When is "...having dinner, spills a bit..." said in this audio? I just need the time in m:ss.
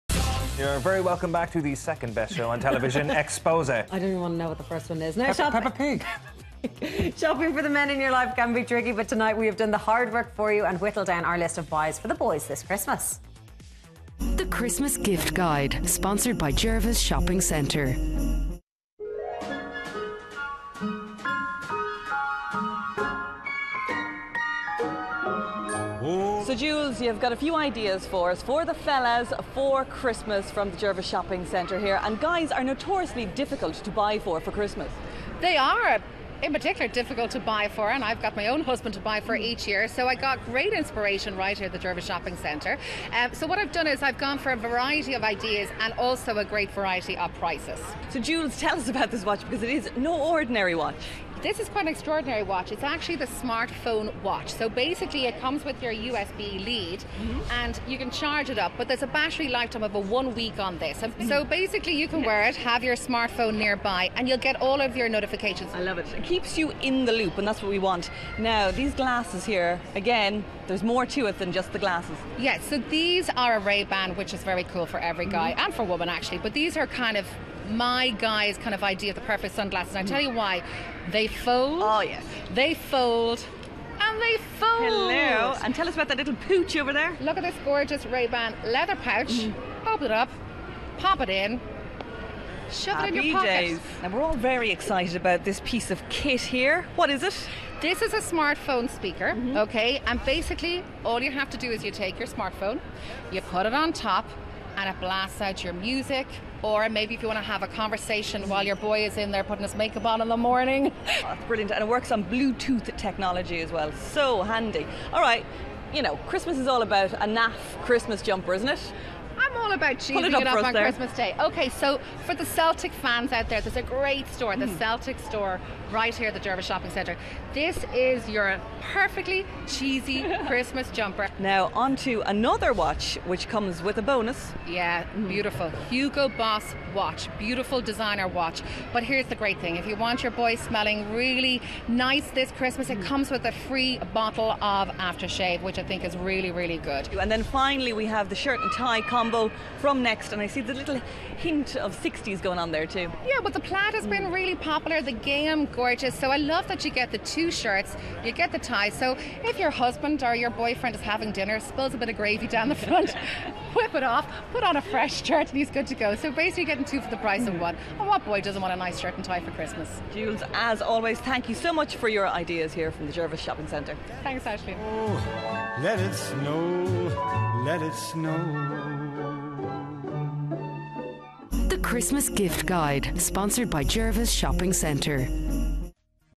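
2:41.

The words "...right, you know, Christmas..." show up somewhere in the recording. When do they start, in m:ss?
1:55.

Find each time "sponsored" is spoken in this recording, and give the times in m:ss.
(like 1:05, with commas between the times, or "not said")
0:15, 3:03.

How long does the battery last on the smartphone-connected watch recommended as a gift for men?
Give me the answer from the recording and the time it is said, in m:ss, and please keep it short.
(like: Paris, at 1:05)
One week, at 0:59.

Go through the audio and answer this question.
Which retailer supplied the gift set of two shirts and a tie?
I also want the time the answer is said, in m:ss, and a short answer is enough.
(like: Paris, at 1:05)
Next, at 2:30.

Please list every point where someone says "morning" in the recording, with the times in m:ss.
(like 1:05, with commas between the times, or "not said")
1:50.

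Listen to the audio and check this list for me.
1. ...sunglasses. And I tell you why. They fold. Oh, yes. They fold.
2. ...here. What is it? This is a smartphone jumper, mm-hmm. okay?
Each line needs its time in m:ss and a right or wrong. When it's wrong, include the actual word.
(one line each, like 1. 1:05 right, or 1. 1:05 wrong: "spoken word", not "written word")
1. 1:19 right
2. 1:36 wrong: "speaker", not "jumper".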